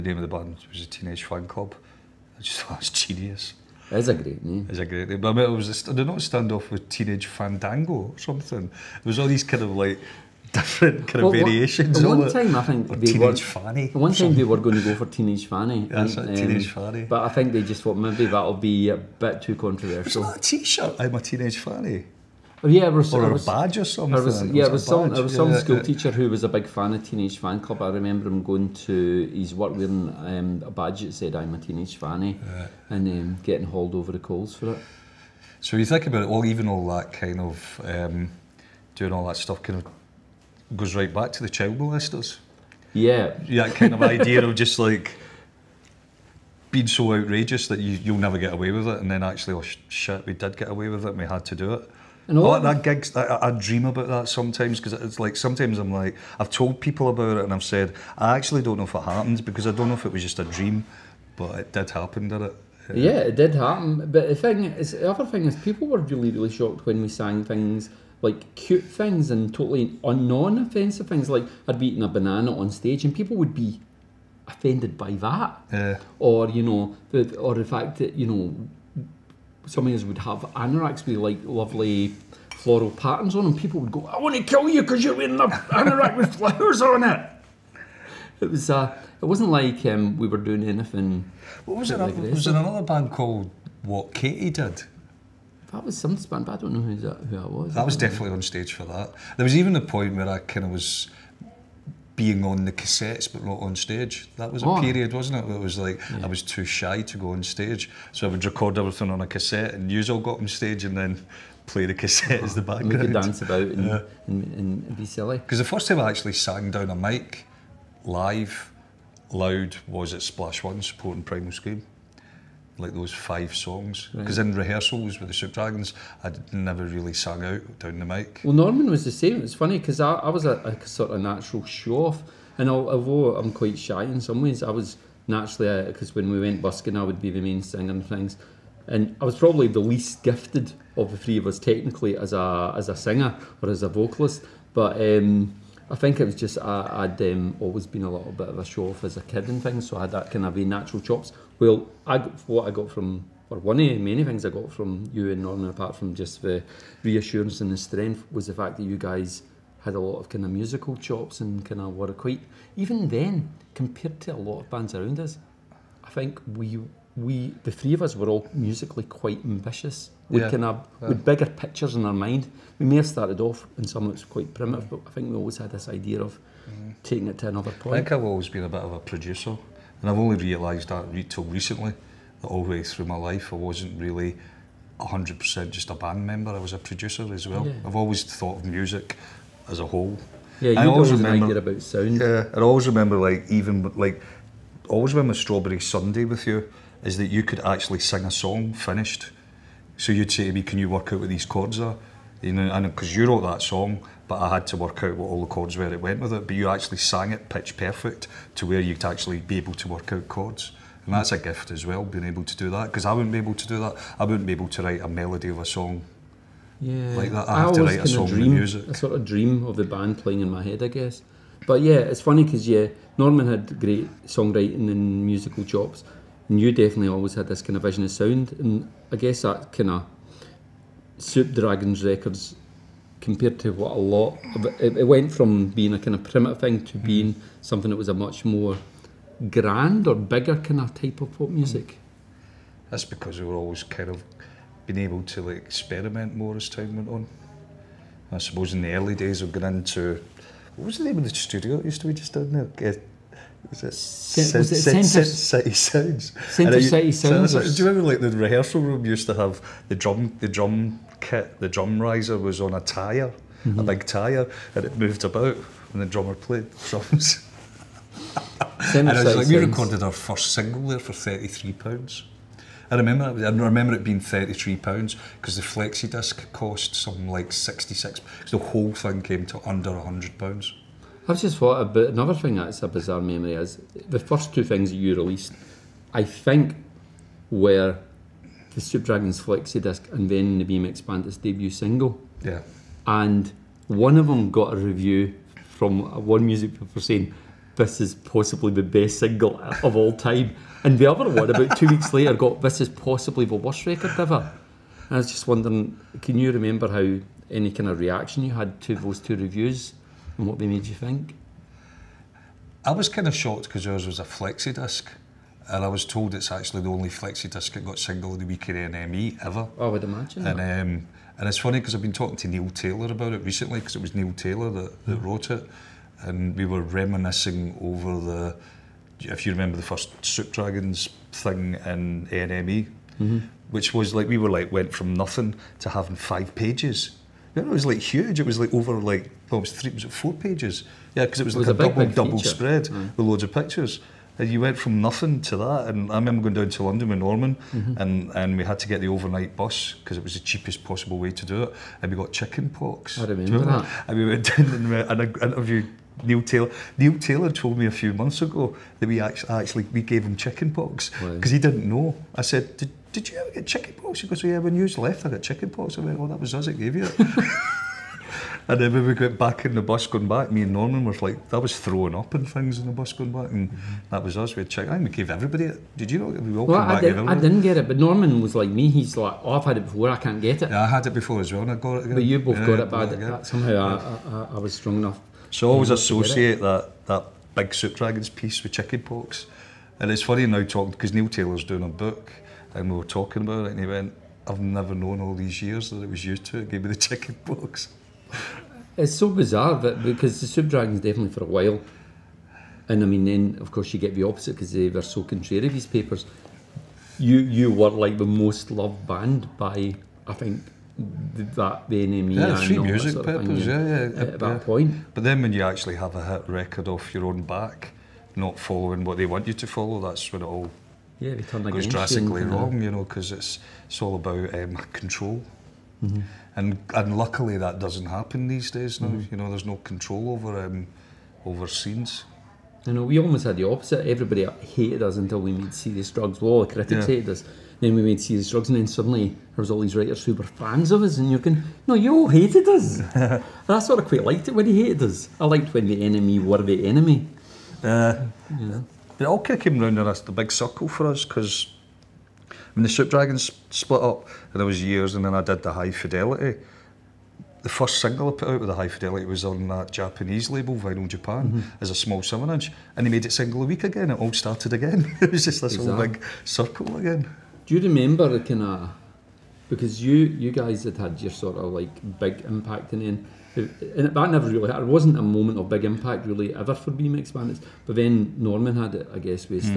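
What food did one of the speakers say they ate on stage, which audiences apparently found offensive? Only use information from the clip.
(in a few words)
A banana.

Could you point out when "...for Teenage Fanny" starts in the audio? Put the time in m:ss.
0:14.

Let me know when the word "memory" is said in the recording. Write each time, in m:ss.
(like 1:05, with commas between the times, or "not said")
4:43.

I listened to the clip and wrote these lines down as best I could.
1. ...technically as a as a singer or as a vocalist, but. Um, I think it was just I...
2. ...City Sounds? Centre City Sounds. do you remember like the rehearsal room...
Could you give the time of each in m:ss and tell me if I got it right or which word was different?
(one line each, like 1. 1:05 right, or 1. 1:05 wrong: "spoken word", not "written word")
1. 2:21 right
2. 4:14 right.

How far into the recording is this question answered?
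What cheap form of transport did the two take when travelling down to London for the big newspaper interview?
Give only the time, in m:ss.
5:49.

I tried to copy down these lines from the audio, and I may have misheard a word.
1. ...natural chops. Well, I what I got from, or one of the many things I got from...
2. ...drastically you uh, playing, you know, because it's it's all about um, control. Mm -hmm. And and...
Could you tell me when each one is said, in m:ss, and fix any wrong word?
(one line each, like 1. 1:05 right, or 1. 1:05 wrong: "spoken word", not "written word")
1. 2:30 right
2. 7:01 wrong: "wrong", not "playing".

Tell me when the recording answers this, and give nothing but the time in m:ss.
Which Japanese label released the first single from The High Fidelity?
7:40.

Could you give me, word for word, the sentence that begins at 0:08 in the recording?
It was all these kind of like different kind well, of variations.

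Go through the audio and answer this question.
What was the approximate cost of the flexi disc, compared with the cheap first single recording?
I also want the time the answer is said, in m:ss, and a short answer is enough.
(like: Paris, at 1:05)
66 pounds, at 4:37.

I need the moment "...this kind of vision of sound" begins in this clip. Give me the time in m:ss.
3:47.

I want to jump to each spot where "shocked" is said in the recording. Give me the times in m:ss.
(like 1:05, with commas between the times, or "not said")
1:06, 5:13.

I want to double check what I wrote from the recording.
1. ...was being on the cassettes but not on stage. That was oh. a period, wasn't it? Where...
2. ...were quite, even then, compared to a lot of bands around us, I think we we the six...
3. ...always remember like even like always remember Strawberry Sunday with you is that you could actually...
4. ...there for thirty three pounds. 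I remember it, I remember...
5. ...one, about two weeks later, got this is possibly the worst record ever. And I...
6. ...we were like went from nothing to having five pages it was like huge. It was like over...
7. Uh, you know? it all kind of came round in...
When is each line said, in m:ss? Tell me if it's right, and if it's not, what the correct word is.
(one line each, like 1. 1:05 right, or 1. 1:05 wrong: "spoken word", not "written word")
1. 1:40 right
2. 2:41 wrong: "three", not "six"
3. 3:12 right
4. 4:30 right
5. 5:01 right
6. 5:34 right
7. 7:27 right.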